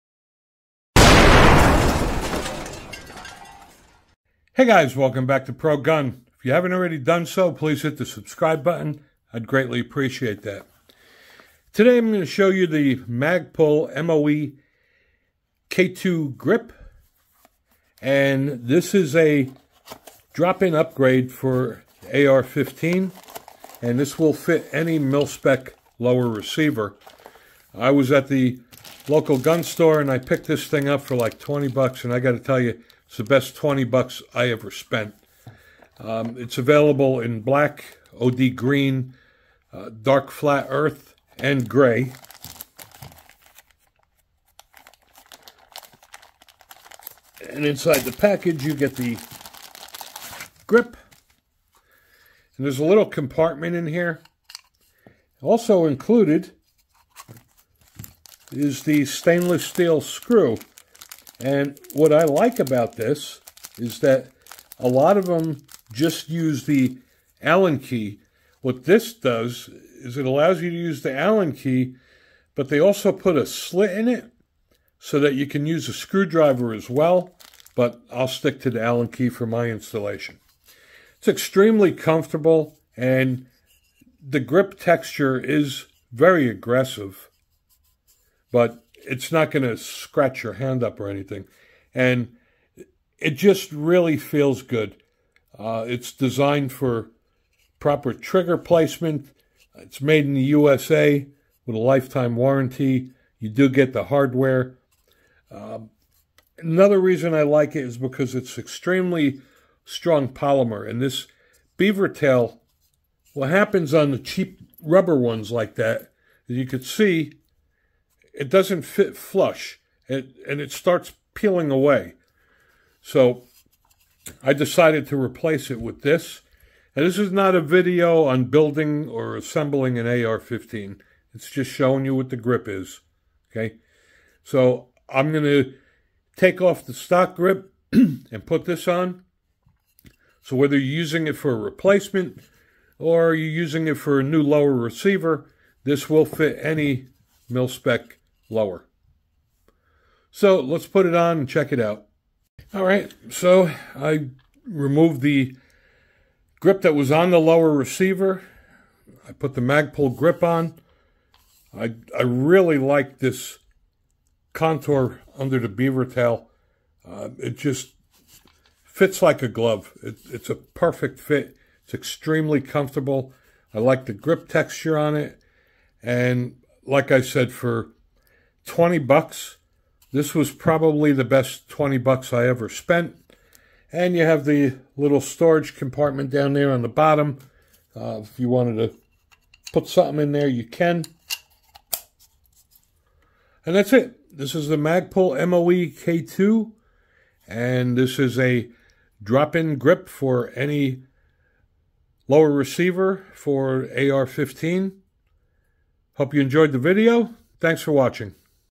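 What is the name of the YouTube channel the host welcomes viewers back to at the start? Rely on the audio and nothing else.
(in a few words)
Pro Gun.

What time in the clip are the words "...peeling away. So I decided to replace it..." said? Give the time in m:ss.
2:01.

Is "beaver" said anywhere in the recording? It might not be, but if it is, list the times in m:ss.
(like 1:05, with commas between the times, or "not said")
1:51, 2:45.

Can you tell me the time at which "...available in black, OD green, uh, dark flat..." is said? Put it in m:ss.
0:36.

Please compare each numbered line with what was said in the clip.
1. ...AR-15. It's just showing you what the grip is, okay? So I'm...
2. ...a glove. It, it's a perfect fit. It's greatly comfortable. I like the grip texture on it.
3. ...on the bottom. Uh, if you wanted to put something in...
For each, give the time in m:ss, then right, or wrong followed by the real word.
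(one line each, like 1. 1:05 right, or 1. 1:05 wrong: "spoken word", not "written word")
1. 2:10 right
2. 2:49 wrong: "extremely", not "greatly"
3. 3:06 right.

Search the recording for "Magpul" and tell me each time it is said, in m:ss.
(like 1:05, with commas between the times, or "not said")
0:12, 2:39, 3:14.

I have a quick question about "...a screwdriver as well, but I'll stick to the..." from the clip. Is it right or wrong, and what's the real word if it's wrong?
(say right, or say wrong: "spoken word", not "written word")
right.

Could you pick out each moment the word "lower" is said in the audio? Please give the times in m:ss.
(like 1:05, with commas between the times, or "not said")
0:25, 2:24, 2:28, 2:37, 3:22.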